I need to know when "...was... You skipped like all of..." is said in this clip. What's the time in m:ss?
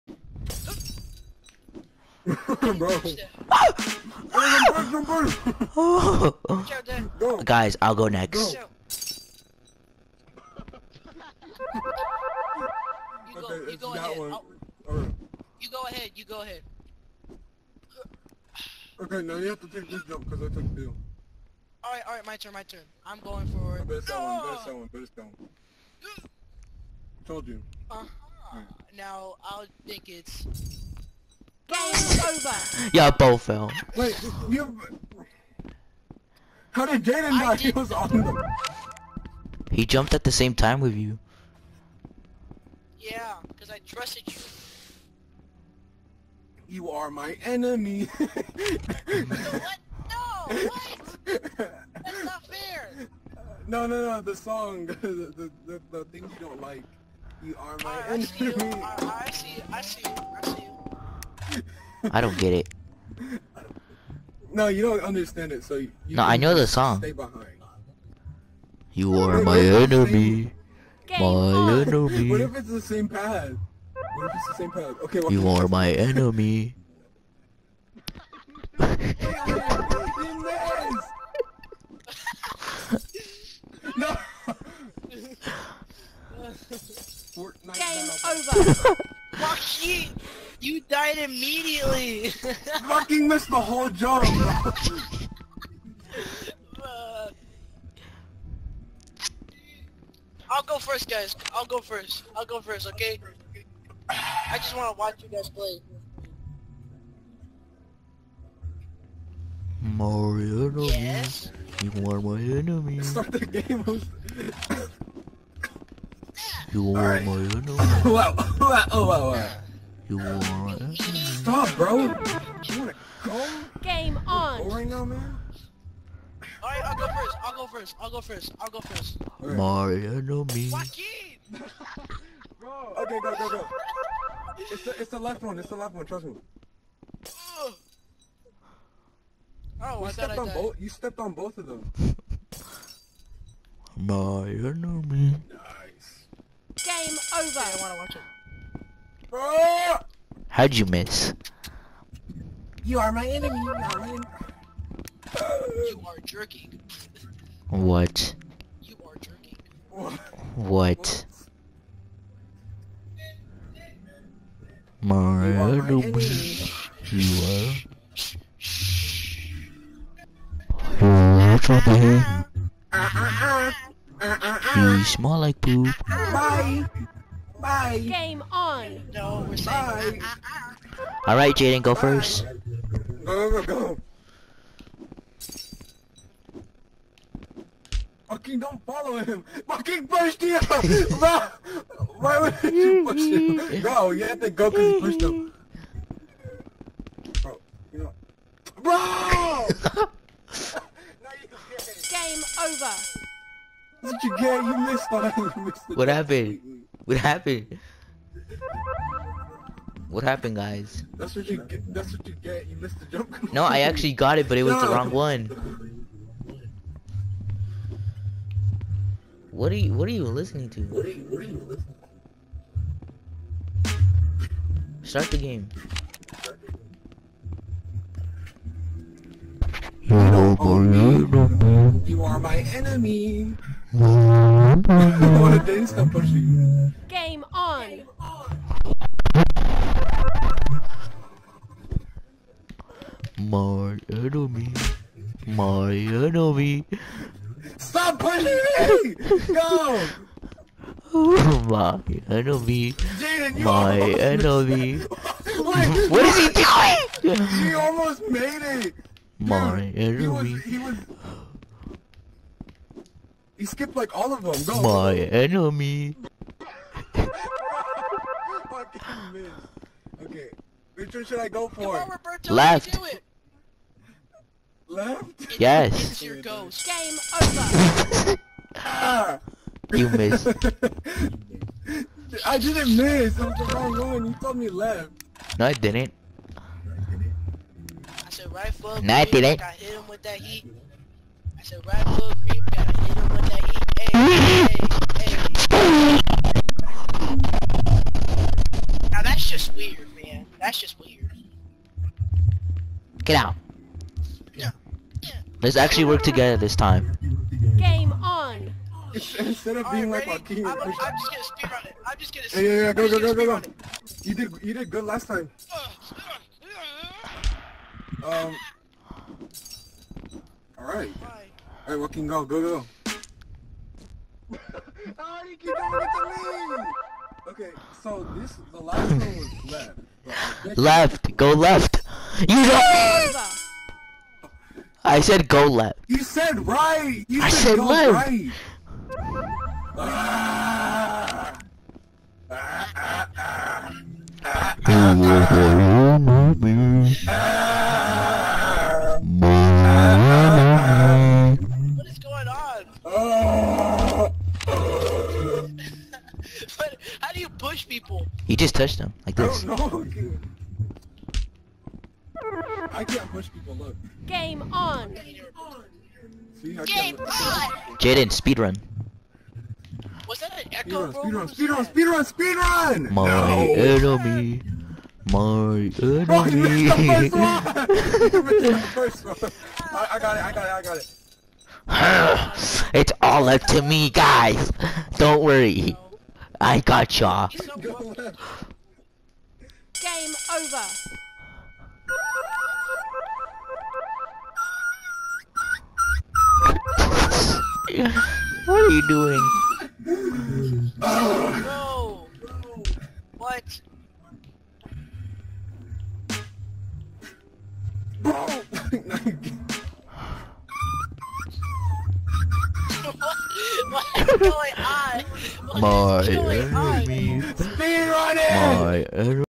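4:20.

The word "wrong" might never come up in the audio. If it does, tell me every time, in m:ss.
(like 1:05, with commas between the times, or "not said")
3:34, 4:43.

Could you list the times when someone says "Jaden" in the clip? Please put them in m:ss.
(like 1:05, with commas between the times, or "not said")
0:37, 3:01, 6:07.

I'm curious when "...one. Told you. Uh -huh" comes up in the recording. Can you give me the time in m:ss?
0:25.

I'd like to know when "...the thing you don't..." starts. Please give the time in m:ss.
0:55.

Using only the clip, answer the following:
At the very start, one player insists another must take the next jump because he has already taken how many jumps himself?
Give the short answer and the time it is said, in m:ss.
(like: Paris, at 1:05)
2, at 0:20.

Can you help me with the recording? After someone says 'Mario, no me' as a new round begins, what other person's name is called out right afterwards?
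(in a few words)
Joaquin.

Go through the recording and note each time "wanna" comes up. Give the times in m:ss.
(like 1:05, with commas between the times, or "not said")
2:02, 2:27.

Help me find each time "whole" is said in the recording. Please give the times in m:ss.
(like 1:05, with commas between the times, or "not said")
1:33.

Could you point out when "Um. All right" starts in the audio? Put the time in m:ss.
5:18.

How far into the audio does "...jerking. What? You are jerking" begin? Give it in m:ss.
2:36.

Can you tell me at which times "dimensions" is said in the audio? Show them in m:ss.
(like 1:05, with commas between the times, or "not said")
not said.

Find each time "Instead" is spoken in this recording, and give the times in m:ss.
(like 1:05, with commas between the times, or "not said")
5:09.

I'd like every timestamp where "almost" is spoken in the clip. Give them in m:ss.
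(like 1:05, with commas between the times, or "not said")
4:17.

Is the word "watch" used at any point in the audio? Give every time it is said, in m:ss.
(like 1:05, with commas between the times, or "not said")
1:44, 2:27.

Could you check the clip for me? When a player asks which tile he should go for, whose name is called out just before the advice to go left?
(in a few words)
Roberto.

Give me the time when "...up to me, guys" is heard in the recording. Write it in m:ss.
6:23.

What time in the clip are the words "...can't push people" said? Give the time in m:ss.
6:03.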